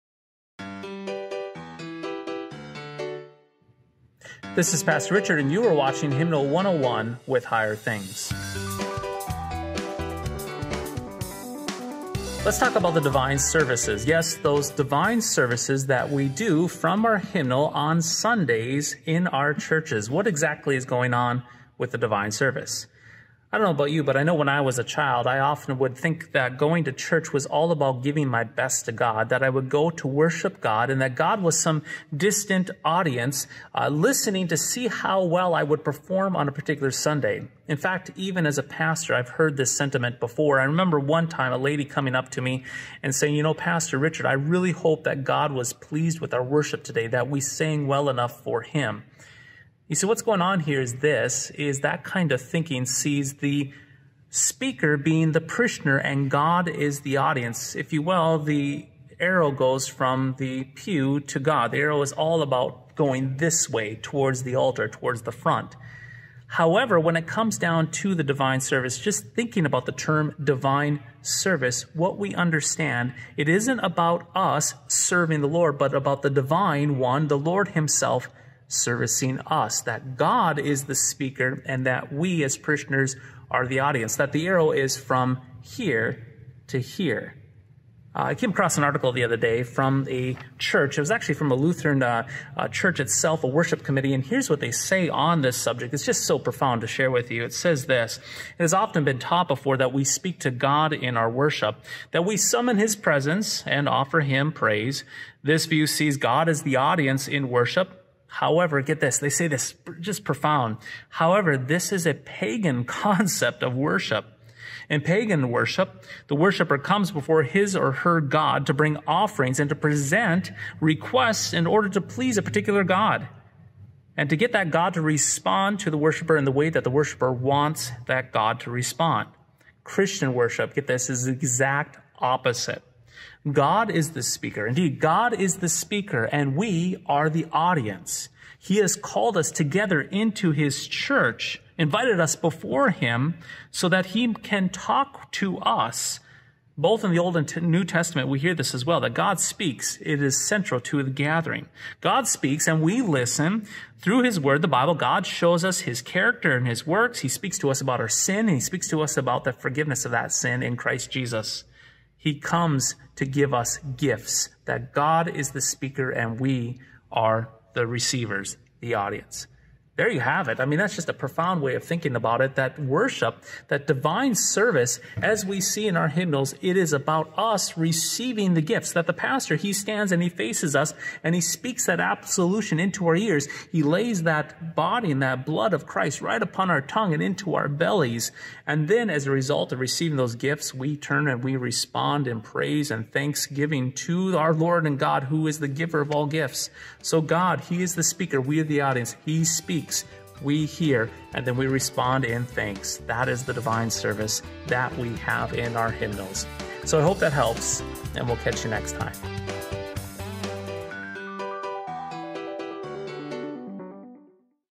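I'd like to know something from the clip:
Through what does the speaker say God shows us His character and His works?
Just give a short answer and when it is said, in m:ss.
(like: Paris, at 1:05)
the Bible, at 2:34.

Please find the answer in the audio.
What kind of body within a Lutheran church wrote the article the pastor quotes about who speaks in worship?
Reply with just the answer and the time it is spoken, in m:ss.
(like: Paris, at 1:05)
worship committee, at 1:33.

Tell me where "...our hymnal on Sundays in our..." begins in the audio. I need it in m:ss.
0:17.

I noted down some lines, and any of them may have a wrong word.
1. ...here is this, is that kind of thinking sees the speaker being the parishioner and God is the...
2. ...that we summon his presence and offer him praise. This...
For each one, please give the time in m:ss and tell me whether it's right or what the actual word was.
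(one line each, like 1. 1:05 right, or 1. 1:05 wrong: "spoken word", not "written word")
1. 0:50 right
2. 1:42 right.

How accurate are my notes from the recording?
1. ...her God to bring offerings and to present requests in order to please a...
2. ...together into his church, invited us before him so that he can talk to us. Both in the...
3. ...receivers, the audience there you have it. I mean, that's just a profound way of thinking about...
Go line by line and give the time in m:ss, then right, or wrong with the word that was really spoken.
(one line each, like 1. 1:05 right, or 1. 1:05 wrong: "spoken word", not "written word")
1. 1:57 right
2. 2:19 right
3. 2:47 right.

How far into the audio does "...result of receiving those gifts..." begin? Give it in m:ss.
3:09.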